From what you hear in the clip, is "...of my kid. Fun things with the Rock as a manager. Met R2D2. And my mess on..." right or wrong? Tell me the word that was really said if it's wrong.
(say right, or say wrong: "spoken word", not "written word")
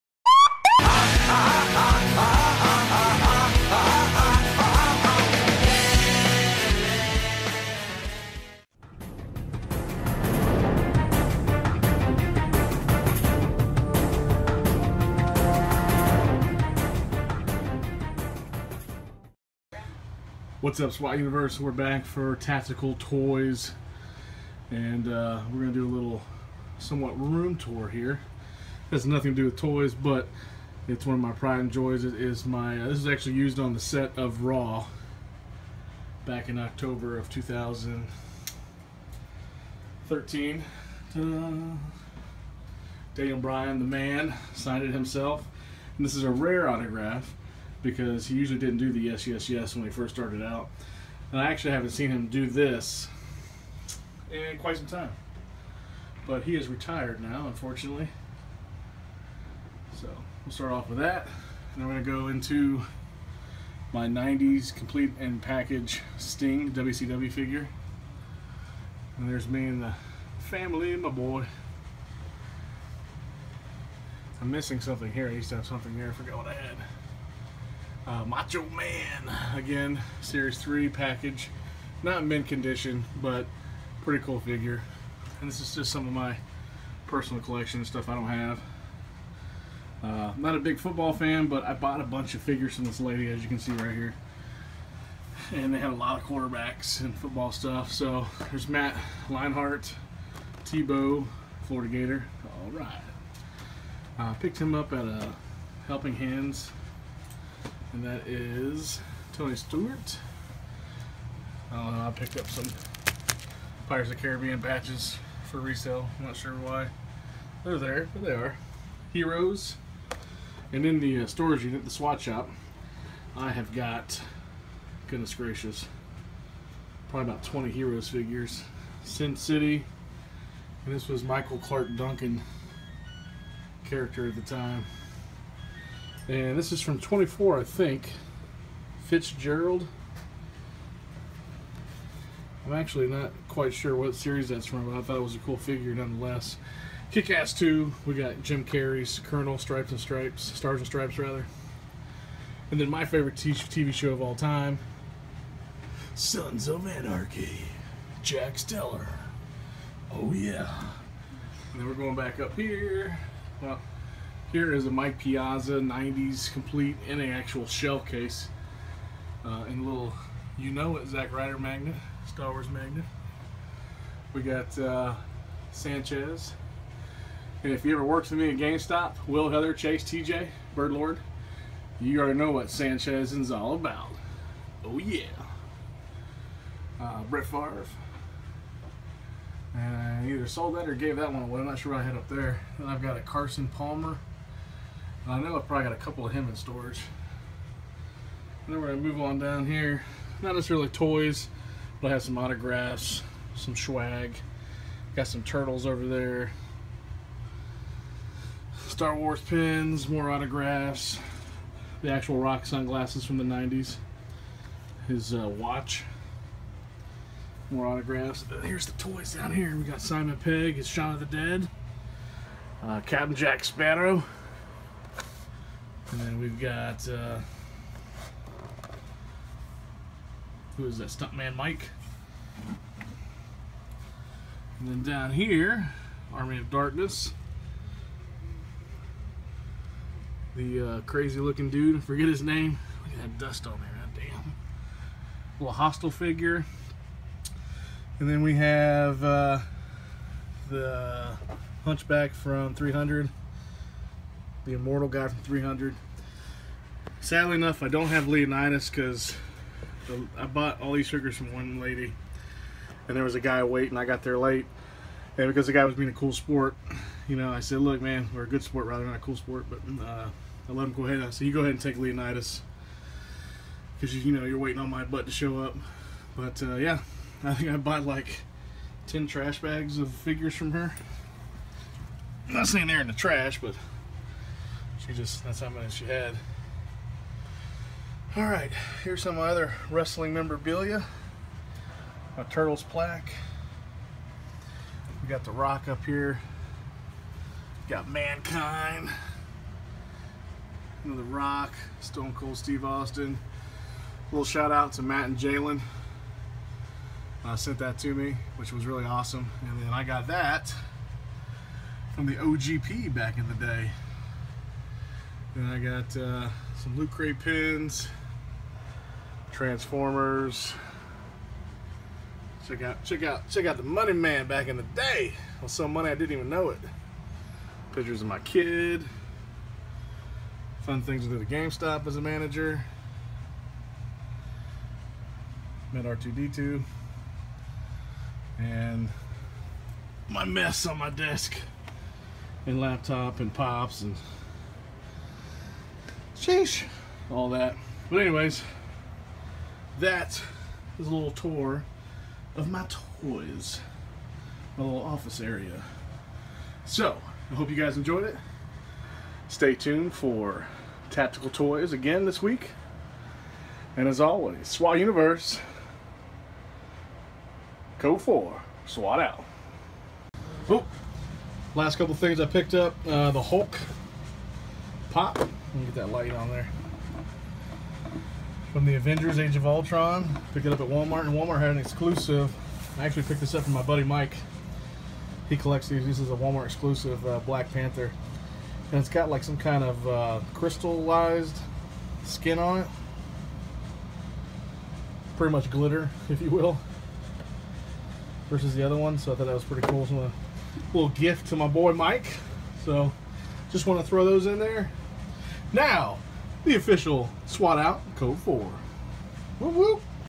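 wrong: "GameStop", not "Rock".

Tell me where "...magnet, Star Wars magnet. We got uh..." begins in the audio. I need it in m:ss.
2:51.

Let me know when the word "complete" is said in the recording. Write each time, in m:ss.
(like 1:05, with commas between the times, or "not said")
1:04, 2:46.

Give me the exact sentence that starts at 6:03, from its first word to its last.
And as always, SWAT Universe, code 4, SWAT out.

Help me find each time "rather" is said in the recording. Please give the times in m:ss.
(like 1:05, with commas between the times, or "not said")
2:31, 4:28.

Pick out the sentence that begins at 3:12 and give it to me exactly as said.
Then I've got a Carson Palmer.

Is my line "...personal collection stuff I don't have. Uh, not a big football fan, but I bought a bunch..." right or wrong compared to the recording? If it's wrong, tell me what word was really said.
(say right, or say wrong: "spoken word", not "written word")
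right.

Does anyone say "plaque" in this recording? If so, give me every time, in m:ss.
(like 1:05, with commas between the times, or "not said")
4:52.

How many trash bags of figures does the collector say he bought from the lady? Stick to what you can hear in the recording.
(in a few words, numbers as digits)
10.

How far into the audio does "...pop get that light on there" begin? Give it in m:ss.
6:15.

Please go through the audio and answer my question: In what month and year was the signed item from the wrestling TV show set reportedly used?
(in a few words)
October 2013.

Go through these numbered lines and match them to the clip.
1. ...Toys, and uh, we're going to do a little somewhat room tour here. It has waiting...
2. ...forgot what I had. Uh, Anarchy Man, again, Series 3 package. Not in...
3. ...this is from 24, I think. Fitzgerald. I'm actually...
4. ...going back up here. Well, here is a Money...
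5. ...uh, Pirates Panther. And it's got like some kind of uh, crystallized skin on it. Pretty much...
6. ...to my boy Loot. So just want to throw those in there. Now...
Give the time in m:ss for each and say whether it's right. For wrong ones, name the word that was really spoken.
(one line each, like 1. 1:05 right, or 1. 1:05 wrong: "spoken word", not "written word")
1. 0:22 wrong: "nothing", not "waiting"
2. 1:16 wrong: "Macho", not "Anarchy"
3. 2:16 right
4. 2:41 wrong: "Mike", not "Money"
5. 6:27 wrong: "Black", not "Pirates"
6. 6:41 wrong: "Mike", not "Loot".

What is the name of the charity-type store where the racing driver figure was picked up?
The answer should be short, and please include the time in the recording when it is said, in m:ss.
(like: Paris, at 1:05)
Helping Hands, at 1:45.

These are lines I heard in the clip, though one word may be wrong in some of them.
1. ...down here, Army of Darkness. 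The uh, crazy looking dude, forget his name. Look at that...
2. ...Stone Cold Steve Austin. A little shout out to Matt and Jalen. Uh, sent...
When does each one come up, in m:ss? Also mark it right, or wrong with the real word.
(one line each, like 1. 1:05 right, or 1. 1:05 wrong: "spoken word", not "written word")
1. 3:55 right
2. 5:01 right.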